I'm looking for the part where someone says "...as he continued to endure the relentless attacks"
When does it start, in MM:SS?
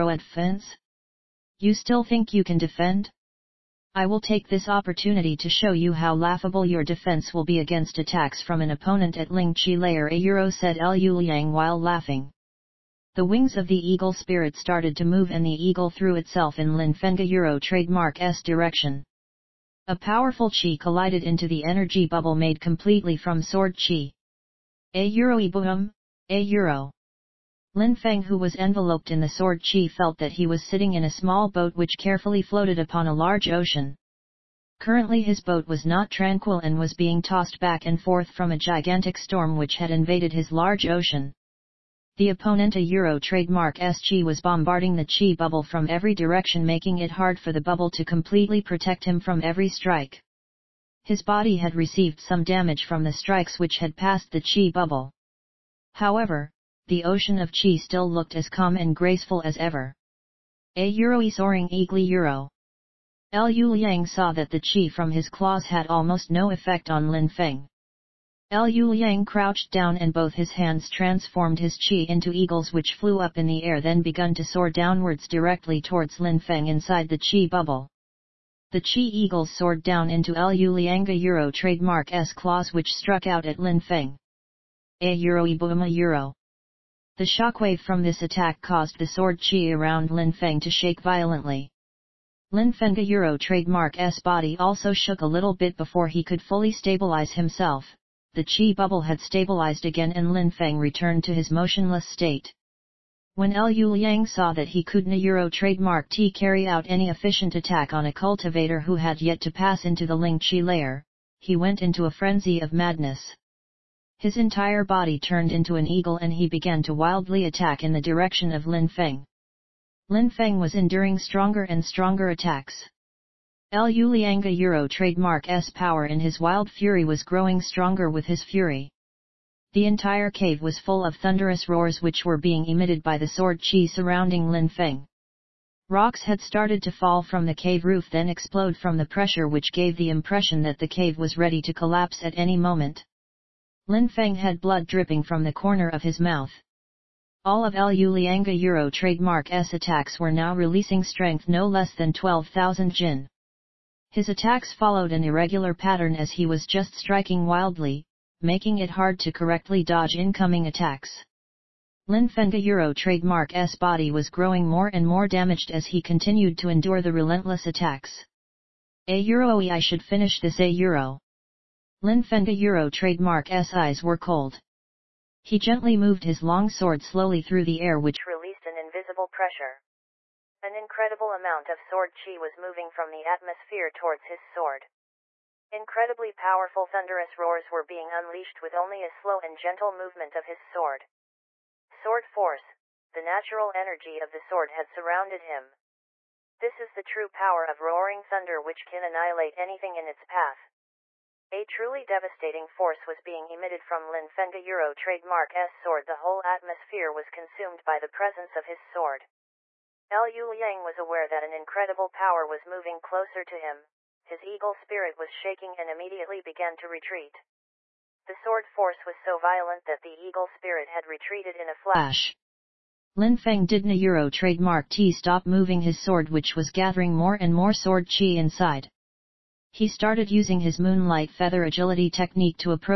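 02:45.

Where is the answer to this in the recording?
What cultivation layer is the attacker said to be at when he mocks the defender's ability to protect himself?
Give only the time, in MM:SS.
00:09.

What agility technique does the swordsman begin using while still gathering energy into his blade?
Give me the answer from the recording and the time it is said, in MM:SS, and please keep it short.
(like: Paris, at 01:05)
moonlight feather agility technique, at 03:50.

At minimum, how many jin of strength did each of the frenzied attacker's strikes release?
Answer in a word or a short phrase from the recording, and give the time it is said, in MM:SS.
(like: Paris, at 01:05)
12,000 jin, at 02:32.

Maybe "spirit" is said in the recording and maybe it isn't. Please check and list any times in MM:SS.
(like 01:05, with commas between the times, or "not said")
00:14, 03:34, 03:40.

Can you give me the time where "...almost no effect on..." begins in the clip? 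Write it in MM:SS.
01:05.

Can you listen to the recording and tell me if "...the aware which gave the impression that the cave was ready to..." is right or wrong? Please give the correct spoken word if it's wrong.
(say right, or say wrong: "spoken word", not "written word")
wrong: "pressure", not "aware".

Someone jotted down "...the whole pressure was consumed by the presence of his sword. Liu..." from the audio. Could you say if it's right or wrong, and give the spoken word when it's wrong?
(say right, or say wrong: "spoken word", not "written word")
wrong: "atmosphere", not "pressure".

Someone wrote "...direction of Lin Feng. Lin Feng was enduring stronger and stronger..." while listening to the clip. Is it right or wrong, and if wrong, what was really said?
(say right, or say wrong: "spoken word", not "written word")
right.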